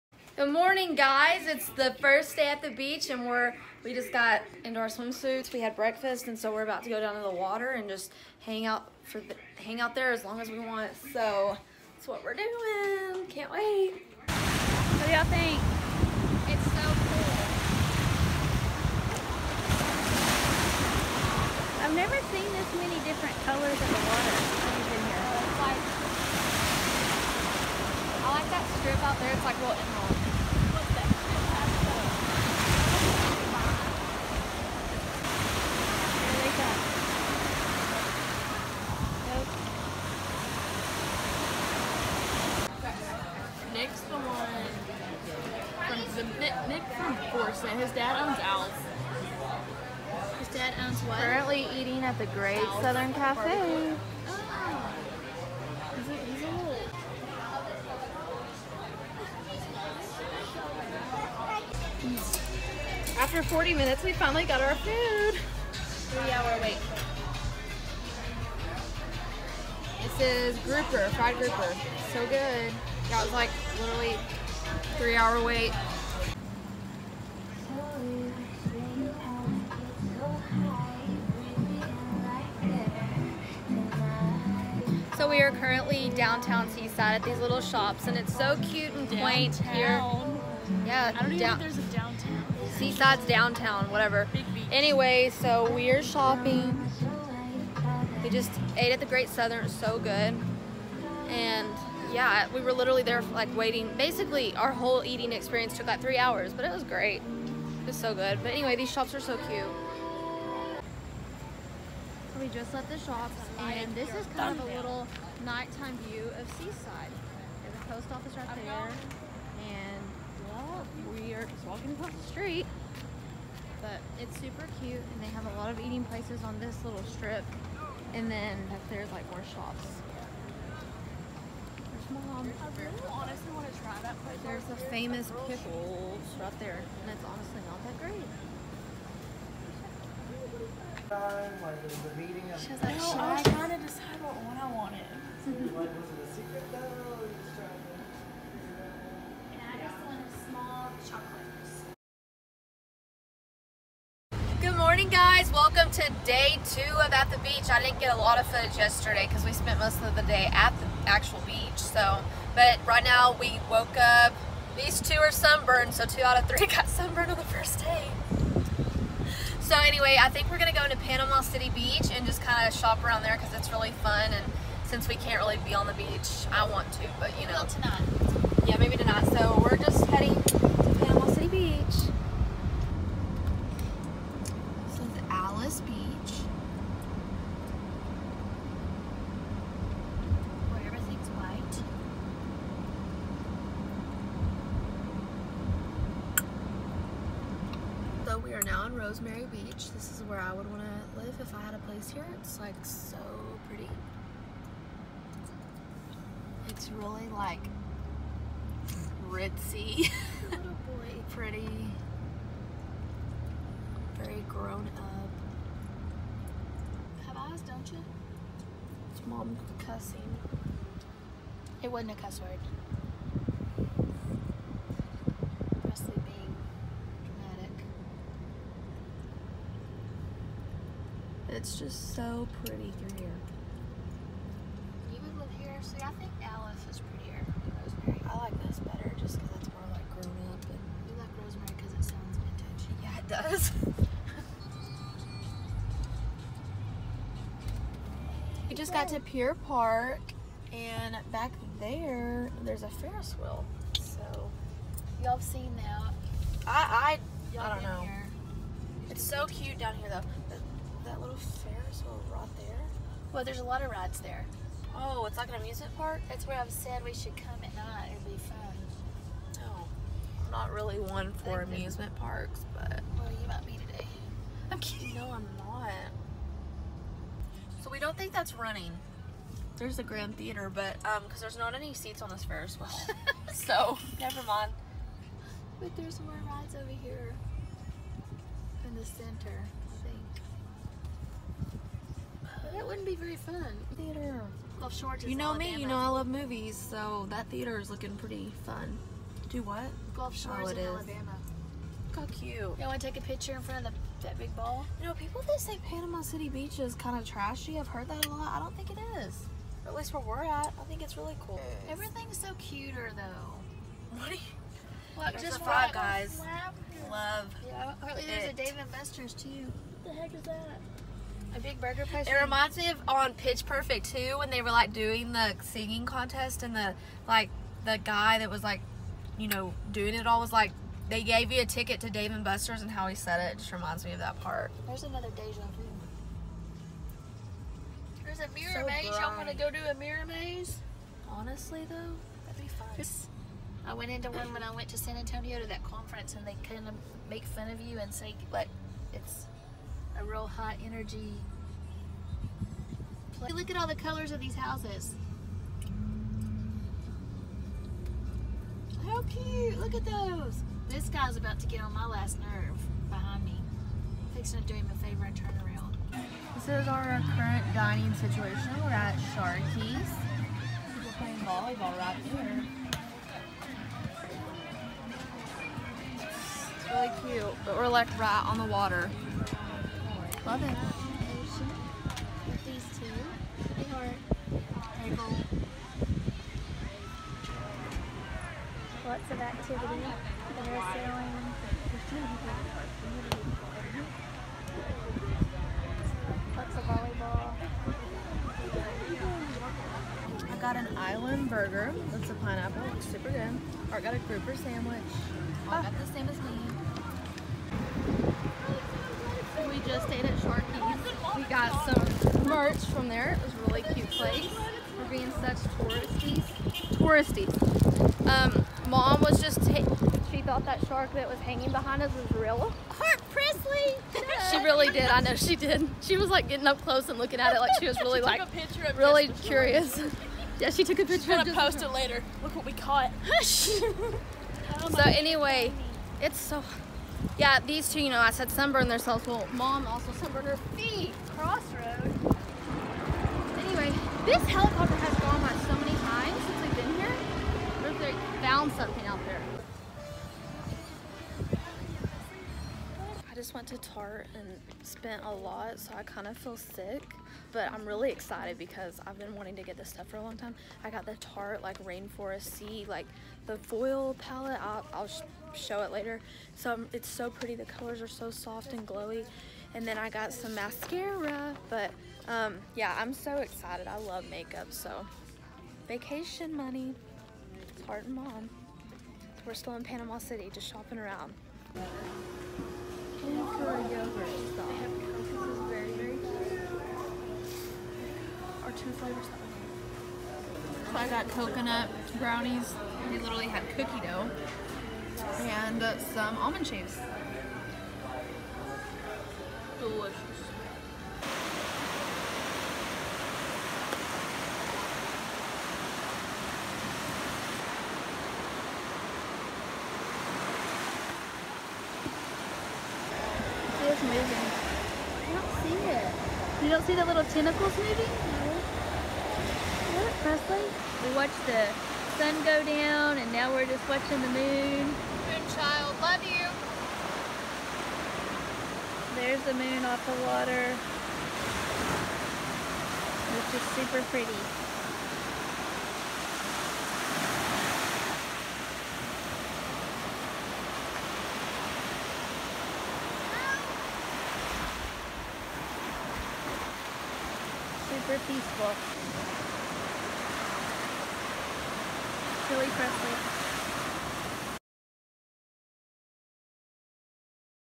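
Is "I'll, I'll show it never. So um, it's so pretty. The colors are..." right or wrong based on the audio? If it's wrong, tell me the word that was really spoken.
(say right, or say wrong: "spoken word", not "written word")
wrong: "later", not "never".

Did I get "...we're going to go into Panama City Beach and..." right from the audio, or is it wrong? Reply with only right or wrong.
right.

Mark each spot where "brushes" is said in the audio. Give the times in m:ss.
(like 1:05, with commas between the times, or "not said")
not said.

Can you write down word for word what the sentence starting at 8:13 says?
They literally had cookie dough and some almond shaves.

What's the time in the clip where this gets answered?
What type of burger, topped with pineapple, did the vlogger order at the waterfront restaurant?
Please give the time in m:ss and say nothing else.
6:40.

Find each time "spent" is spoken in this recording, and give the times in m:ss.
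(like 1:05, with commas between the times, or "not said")
2:39, 7:34.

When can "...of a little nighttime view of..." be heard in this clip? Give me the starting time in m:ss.
1:54.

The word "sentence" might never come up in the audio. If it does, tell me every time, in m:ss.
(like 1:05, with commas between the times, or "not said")
not said.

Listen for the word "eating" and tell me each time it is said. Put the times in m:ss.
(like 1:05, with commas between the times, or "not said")
0:51, 1:45, 2:05.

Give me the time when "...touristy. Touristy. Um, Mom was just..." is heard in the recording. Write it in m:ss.
6:55.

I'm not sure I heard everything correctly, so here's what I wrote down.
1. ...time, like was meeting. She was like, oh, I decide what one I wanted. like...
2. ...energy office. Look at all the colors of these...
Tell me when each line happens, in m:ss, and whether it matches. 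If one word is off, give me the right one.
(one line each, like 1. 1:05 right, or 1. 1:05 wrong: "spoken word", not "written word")
1. 2:21 right
2. 5:50 wrong: "place", not "office".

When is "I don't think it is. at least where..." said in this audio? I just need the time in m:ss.
5:08.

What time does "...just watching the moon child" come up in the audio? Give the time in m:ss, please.
8:43.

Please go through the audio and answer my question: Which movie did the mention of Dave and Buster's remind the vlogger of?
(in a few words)
Pitch Perfect.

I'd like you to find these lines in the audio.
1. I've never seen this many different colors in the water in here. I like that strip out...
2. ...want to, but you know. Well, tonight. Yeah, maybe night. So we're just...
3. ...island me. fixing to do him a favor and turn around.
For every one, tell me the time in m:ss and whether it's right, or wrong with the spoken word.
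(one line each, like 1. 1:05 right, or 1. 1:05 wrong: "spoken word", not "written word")
1. 0:21 right
2. 2:56 wrong: "tonight", not "night"
3. 6:03 wrong: "behind", not "island".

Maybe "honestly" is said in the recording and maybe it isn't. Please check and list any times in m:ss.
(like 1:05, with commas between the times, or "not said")
2:13, 2:17, 5:41.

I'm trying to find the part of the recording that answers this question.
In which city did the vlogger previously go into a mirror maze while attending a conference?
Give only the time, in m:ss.
5:44.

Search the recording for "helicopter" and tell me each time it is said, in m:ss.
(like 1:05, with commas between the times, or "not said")
7:24.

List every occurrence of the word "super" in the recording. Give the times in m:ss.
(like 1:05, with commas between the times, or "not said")
2:04, 6:43, 8:53, 9:07.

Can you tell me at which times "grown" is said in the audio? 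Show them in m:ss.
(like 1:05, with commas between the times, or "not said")
3:34, 4:00.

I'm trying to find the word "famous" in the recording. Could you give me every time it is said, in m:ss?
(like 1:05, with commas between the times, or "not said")
2:14.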